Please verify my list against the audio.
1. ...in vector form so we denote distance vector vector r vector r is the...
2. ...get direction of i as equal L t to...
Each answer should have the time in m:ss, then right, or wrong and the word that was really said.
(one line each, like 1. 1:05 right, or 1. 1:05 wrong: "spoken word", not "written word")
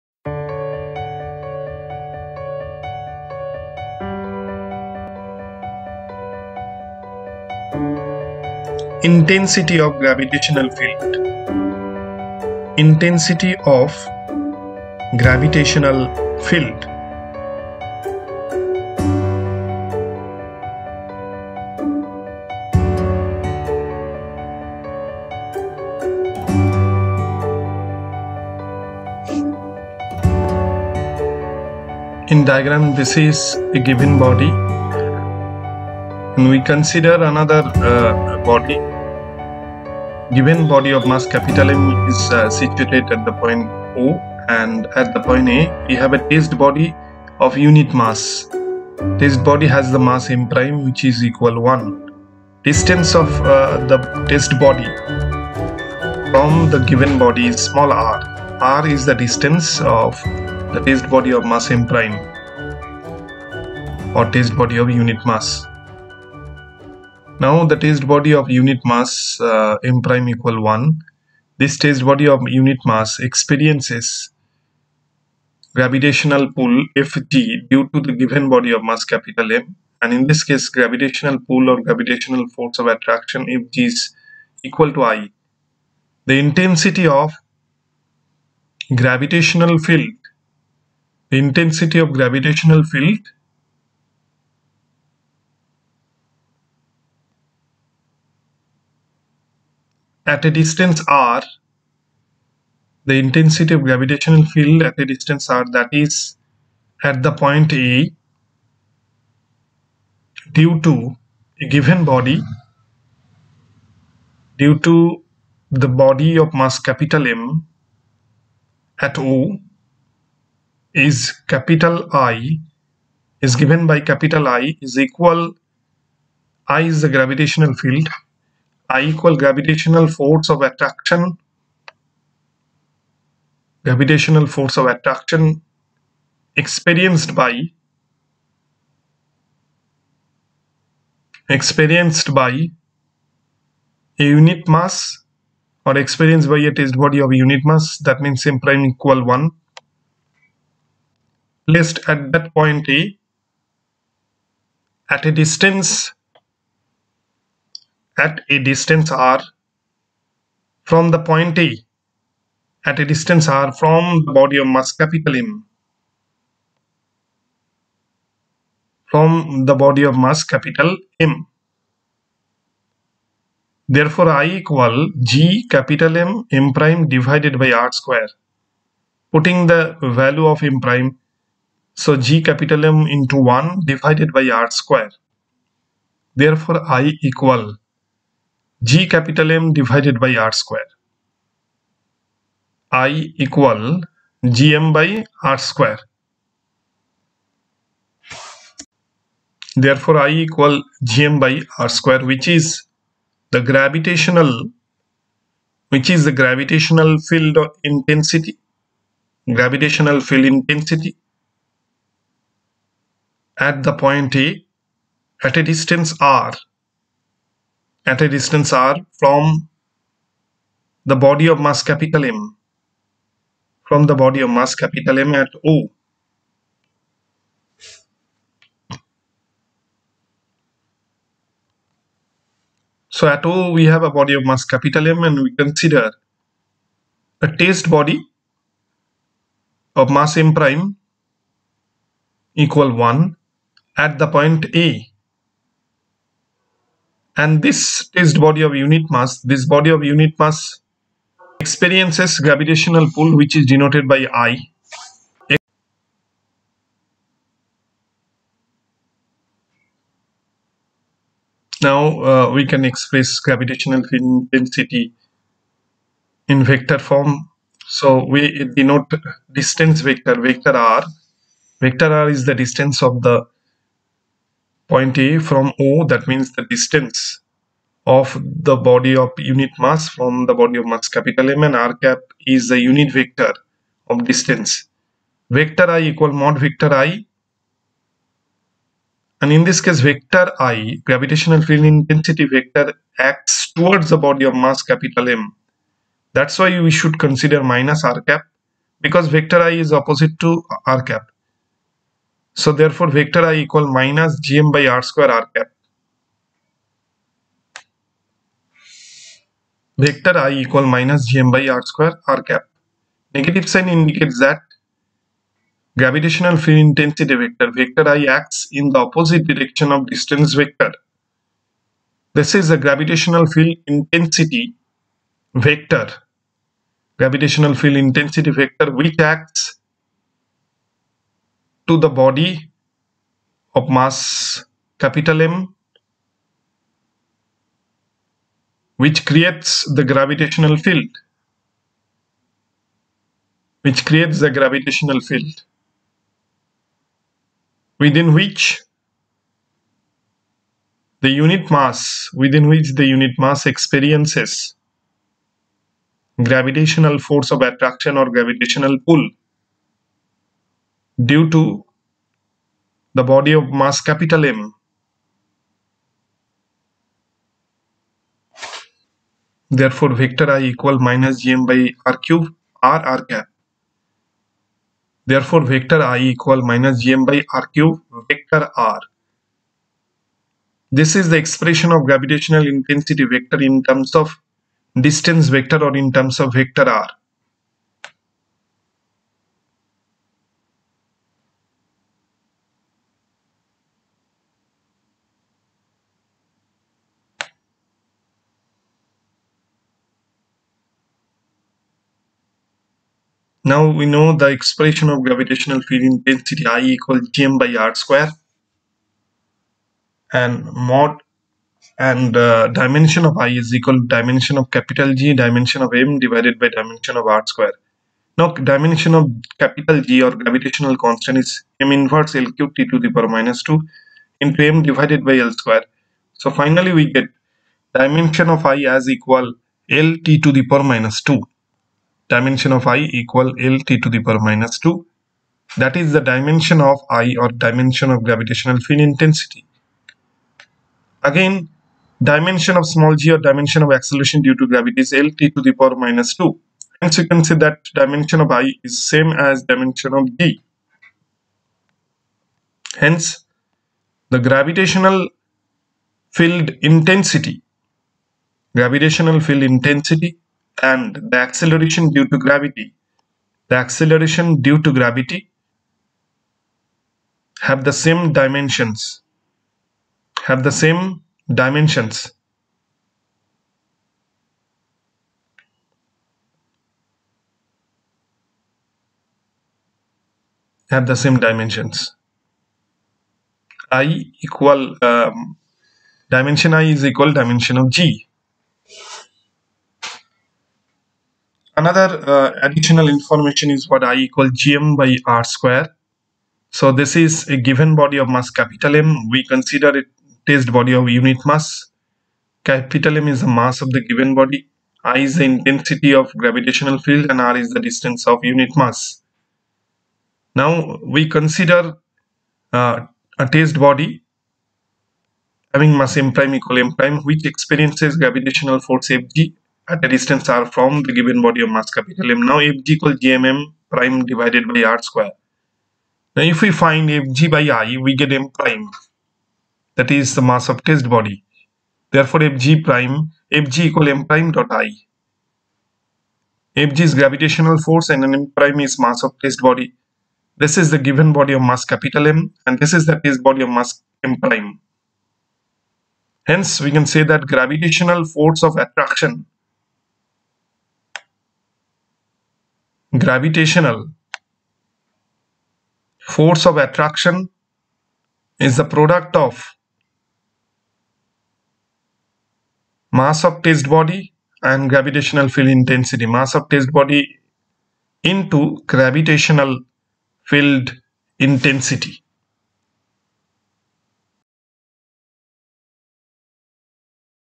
1. 4:26 right
2. 7:07 wrong: "dimension", not "direction".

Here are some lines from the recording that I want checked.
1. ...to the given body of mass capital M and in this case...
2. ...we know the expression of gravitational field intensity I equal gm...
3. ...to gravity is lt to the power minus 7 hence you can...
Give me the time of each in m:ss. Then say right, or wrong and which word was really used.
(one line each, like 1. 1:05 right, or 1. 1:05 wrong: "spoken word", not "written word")
1. 1:17 right
2. 6:43 right
3. 7:24 wrong: "2", not "7".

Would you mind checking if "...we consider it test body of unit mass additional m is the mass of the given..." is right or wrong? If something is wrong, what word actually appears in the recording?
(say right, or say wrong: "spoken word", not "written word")
wrong: "capital", not "additional".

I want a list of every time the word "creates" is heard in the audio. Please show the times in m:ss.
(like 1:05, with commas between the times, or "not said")
5:39, 5:44.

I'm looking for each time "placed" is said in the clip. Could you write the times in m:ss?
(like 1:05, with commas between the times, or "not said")
2:31.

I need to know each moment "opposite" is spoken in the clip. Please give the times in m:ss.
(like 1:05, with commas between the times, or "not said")
4:59, 5:18.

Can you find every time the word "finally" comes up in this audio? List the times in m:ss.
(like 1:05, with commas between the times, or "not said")
7:06.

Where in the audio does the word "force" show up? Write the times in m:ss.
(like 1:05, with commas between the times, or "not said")
1:22, 2:10, 2:14, 5:57, 8:38, 8:57, 9:08, 9:16.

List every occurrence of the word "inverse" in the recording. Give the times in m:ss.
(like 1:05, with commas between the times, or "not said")
7:01.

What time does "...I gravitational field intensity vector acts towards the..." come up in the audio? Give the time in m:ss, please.
4:50.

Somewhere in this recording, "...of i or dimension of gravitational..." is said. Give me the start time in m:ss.
7:16.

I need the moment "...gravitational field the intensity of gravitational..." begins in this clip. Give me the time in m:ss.
1:29.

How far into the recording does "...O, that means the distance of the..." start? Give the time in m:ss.
4:35.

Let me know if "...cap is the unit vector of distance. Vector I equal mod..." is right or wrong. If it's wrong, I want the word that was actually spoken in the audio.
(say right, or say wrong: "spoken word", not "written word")
right.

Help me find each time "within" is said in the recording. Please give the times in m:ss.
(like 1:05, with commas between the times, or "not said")
5:47, 5:52.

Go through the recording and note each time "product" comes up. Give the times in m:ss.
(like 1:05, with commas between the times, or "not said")
9:18.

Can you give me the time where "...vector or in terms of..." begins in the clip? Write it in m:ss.
6:25.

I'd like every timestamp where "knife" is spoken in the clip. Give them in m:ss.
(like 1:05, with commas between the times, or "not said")
not said.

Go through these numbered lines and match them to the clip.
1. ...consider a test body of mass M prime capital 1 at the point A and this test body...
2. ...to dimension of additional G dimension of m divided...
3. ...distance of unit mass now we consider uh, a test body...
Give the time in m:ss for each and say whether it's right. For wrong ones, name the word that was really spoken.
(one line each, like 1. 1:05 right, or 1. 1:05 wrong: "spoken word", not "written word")
1. 3:55 wrong: "equal", not "capital"
2. 6:54 wrong: "capital", not "additional"
3. 8:27 right.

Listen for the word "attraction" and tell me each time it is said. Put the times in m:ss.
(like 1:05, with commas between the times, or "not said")
1:22, 2:10, 2:14, 5:57, 9:08, 9:16.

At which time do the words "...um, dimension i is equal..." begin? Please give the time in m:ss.
8:05.